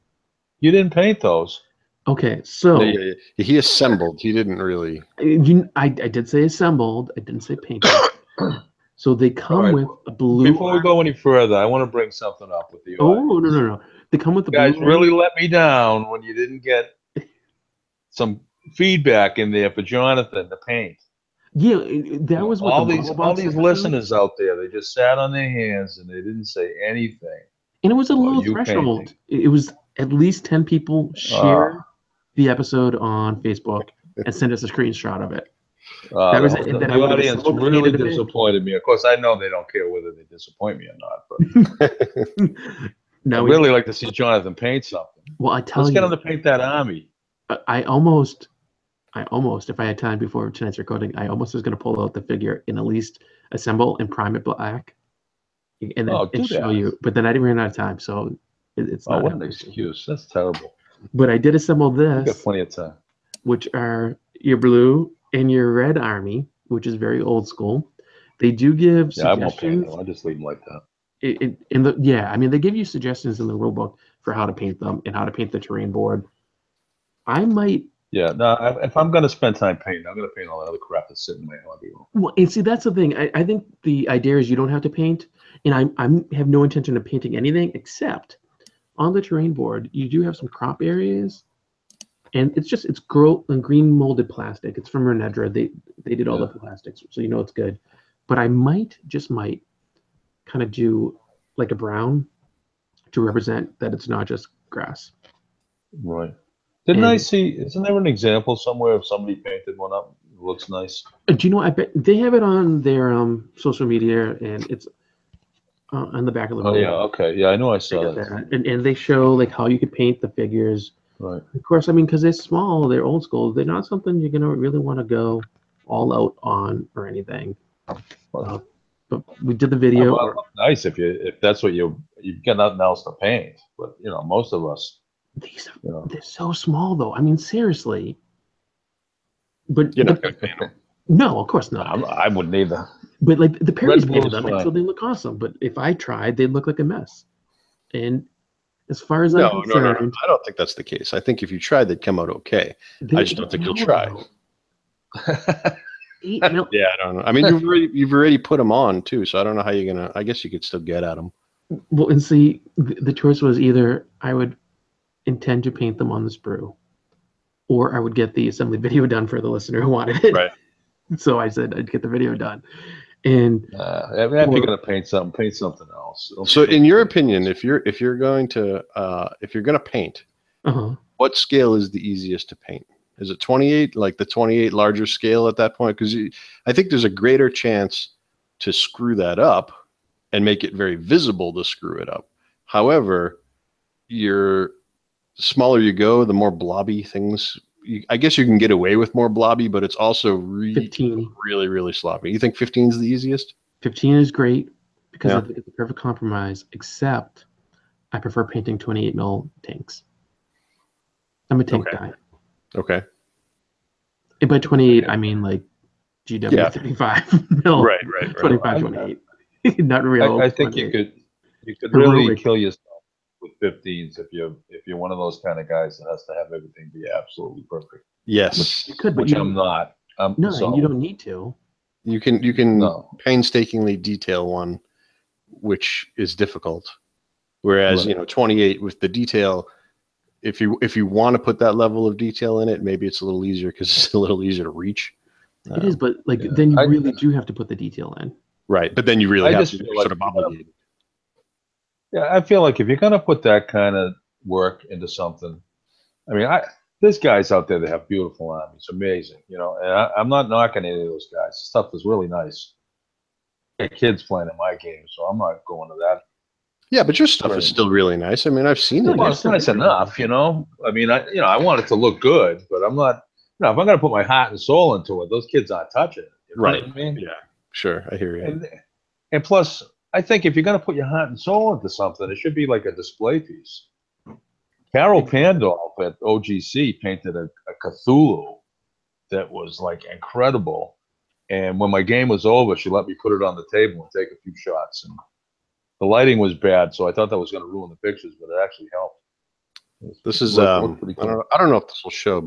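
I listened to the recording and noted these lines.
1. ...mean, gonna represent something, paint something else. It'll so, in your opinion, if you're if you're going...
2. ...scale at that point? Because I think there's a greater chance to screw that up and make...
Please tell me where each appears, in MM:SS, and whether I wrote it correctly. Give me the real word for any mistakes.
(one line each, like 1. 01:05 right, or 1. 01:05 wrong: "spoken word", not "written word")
1. 02:54 wrong: "paint", not "represent"
2. 03:05 right.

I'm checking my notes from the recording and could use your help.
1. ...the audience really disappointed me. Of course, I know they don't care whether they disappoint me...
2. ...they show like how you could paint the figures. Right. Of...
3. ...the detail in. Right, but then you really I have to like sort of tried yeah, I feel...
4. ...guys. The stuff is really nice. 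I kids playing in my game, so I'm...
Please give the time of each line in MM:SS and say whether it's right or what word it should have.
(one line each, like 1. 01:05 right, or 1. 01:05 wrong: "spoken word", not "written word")
1. 00:36 right
2. 01:58 right
3. 04:07 wrong: "obligated", not "tried"
4. 04:21 right.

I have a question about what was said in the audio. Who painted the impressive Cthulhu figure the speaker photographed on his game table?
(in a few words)
Carol Pandolf.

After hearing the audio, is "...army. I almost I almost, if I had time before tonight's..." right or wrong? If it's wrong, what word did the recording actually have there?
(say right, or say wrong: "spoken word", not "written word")
right.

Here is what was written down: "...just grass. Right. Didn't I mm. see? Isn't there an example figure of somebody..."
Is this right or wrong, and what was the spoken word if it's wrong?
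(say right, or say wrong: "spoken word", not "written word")
wrong: "somewhere", not "figure".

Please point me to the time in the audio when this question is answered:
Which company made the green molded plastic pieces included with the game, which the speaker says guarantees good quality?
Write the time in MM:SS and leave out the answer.
01:35.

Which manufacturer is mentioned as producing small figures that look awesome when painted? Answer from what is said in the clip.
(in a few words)
Perry's.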